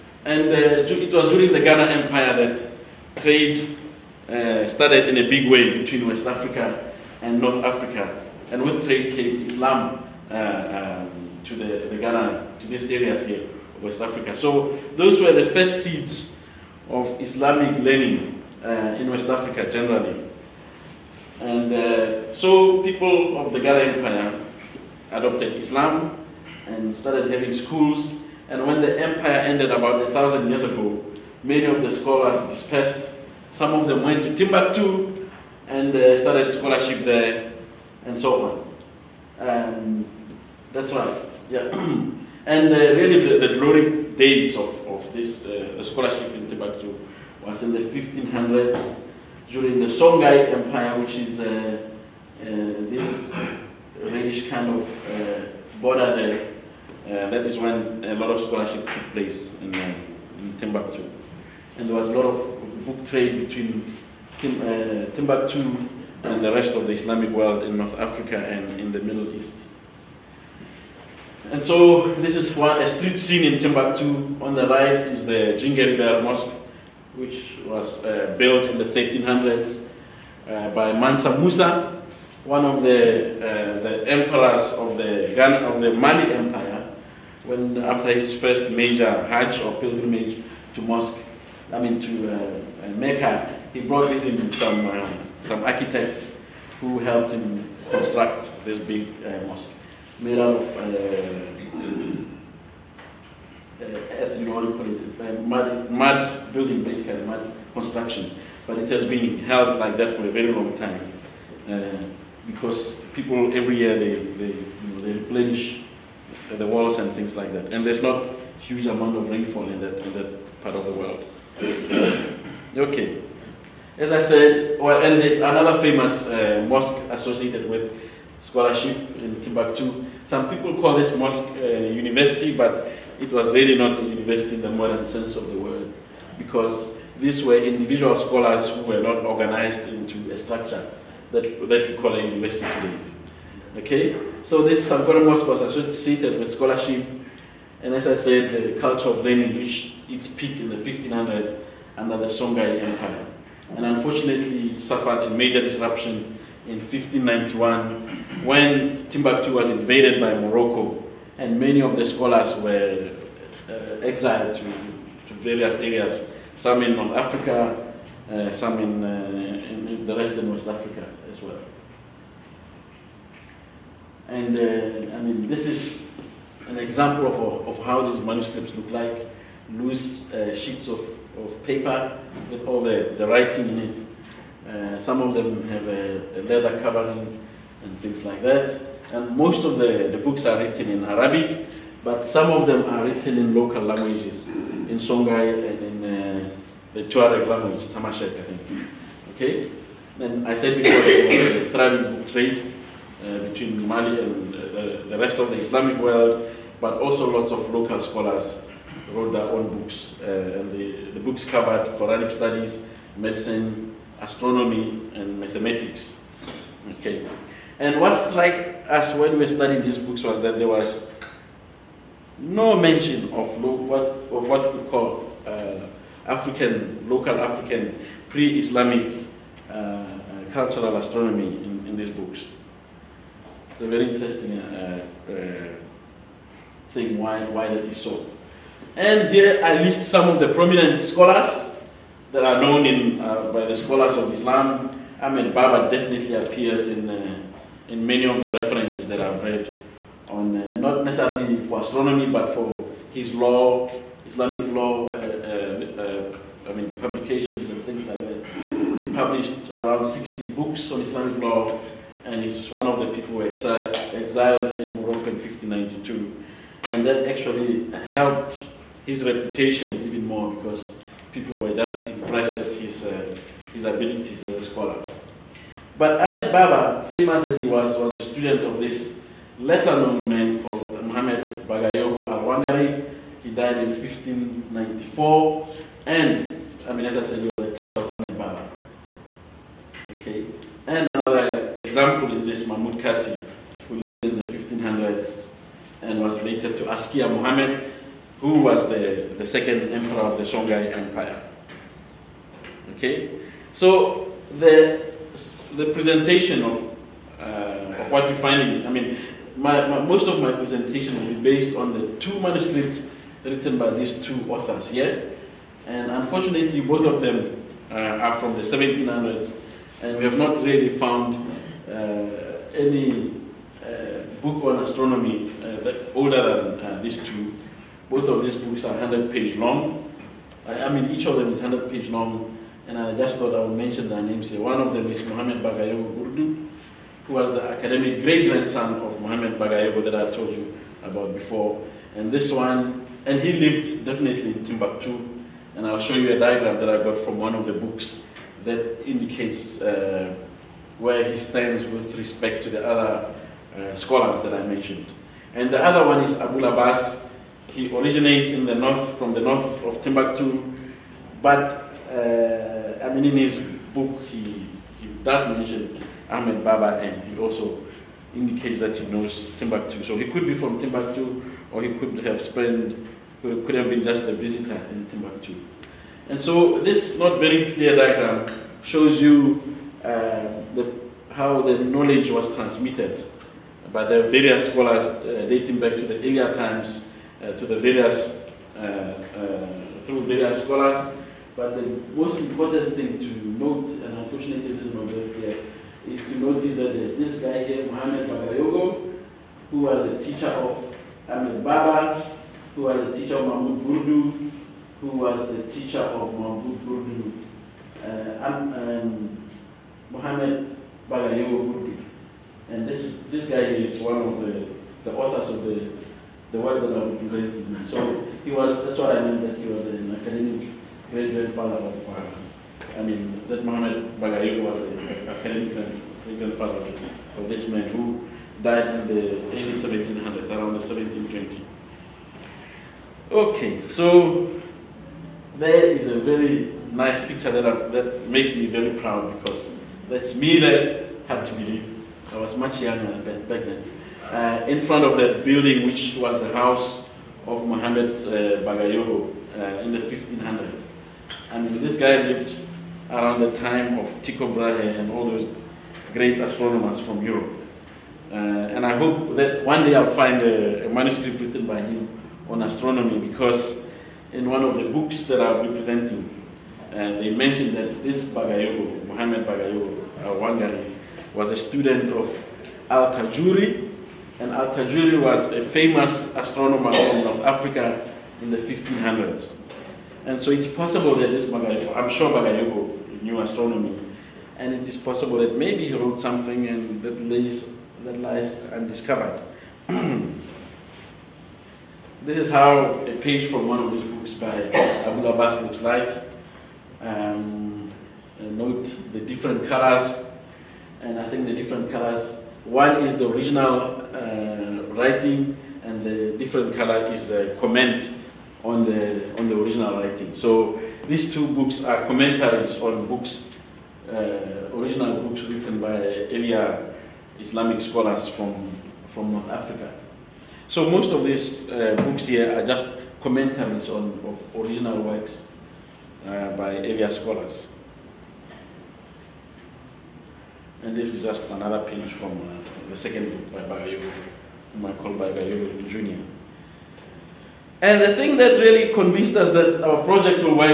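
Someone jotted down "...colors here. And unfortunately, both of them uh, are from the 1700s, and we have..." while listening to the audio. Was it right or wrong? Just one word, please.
wrong.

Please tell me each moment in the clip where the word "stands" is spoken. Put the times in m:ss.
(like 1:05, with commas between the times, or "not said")
5:51.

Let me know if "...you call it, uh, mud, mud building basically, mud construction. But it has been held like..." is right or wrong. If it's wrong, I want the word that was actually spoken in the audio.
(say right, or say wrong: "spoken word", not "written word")
right.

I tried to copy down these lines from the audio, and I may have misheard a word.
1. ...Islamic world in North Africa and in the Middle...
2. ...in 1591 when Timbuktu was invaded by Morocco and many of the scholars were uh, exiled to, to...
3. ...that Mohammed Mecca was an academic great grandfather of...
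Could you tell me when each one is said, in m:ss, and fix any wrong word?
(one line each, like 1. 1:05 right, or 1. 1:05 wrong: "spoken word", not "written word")
1. 1:06 right
2. 2:36 right
3. 7:03 wrong: "Bagayoko", not "Mecca".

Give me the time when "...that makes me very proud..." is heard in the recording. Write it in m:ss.
7:17.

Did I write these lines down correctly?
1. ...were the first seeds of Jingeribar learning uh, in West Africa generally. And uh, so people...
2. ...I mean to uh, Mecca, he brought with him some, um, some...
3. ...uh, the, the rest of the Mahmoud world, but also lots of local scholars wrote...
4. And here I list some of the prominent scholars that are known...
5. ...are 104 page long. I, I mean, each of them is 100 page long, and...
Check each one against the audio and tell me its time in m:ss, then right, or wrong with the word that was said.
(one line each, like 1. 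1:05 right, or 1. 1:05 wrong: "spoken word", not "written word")
1. 0:15 wrong: "Islamic", not "Jingeribar"
2. 1:31 right
3. 3:24 wrong: "Islamic", not "Mahmoud"
4. 3:58 right
5. 5:28 wrong: "100", not "104".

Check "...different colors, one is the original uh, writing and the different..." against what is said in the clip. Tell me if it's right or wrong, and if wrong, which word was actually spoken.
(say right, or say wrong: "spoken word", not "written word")
right.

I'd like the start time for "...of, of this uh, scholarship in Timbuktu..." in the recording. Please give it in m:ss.
0:44.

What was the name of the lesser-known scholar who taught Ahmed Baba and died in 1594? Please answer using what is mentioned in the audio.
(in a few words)
Muhammad Bagayogo Al-Wangari.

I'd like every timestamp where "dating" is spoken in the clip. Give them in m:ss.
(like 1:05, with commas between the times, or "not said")
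6:25.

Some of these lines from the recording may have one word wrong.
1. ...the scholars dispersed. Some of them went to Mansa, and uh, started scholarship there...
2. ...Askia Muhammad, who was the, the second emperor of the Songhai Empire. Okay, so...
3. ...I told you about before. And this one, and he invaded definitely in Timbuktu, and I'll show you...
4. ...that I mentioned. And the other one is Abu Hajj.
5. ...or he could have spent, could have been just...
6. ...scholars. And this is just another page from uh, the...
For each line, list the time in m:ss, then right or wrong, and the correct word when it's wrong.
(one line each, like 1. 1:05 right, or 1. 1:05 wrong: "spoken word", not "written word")
1. 0:31 wrong: "Timbuktu", not "Mansa"
2. 4:56 right
3. 5:40 wrong: "lived", not "invaded"
4. 5:54 wrong: "Abbas", not "Hajj"
5. 6:11 right
6. 8:47 right.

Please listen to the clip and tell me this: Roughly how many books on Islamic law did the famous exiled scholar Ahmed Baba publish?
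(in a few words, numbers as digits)
60.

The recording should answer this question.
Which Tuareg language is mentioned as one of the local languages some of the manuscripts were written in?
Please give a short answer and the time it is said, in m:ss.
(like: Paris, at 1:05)
Tamashek, at 3:17.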